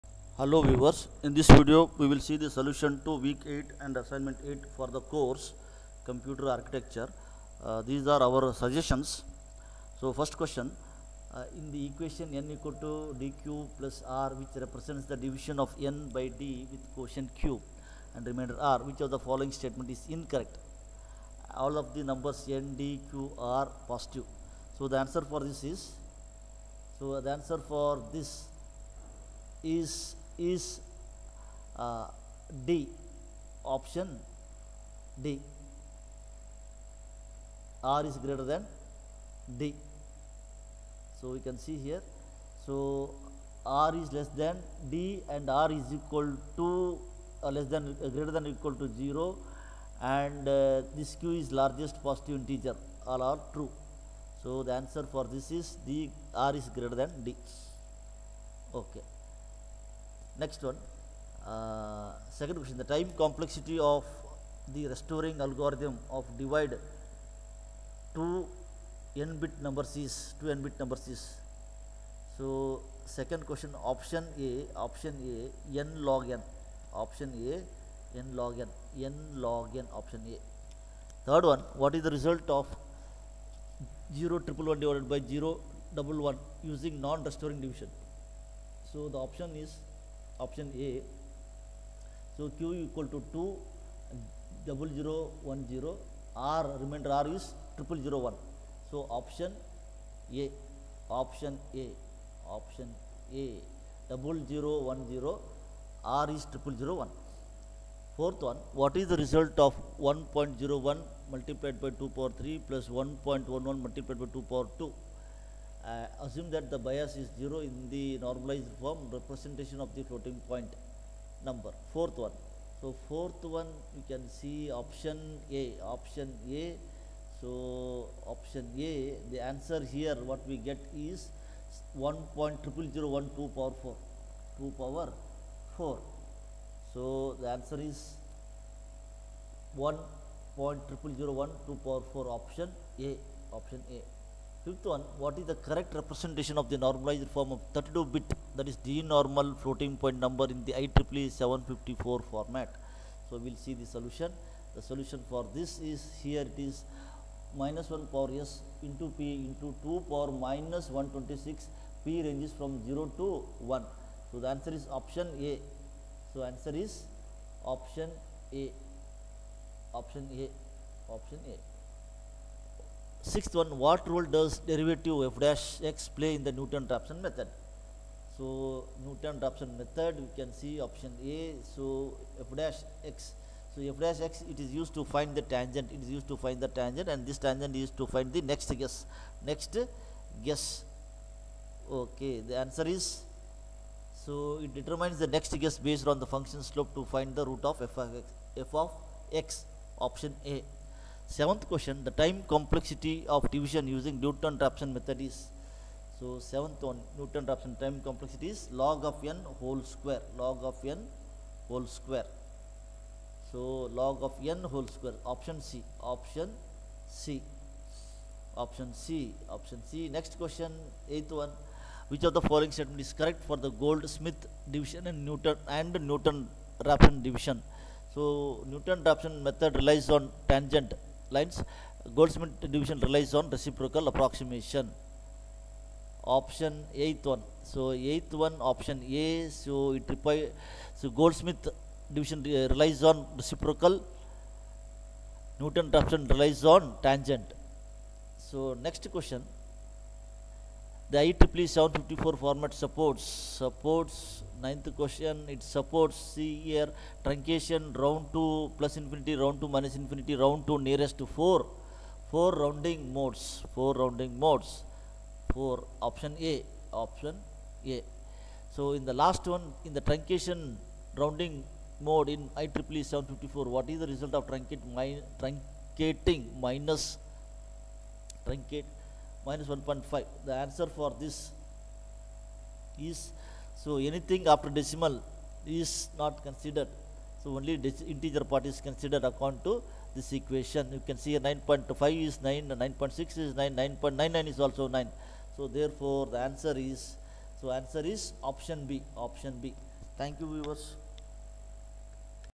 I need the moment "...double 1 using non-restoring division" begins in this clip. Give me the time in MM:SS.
01:25.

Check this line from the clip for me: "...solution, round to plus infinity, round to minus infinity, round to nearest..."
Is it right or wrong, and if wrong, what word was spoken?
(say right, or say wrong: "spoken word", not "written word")
wrong: "truncation", not "solution".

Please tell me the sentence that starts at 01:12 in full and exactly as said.
So, second question, option A, option A, n log n, option A, n log n, n log n, option A.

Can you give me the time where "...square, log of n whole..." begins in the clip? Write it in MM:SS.
03:29.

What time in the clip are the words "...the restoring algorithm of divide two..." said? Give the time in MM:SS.
01:04.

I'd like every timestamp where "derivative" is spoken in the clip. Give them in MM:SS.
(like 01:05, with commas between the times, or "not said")
02:54.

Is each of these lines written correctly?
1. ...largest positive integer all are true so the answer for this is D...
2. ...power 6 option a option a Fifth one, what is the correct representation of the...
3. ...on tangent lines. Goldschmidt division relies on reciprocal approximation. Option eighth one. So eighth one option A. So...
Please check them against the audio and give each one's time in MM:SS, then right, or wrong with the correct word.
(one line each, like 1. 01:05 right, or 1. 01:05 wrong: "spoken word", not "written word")
1. 00:51 right
2. 02:21 wrong: "4", not "6"
3. 03:50 right.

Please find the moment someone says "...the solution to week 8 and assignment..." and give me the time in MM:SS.
00:02.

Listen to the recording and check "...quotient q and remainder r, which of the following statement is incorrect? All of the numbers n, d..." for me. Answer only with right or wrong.
right.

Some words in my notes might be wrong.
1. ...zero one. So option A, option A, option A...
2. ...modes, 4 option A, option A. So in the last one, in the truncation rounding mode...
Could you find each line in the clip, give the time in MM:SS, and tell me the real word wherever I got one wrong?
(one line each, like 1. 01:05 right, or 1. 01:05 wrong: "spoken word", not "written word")
1. 01:38 right
2. 04:24 right.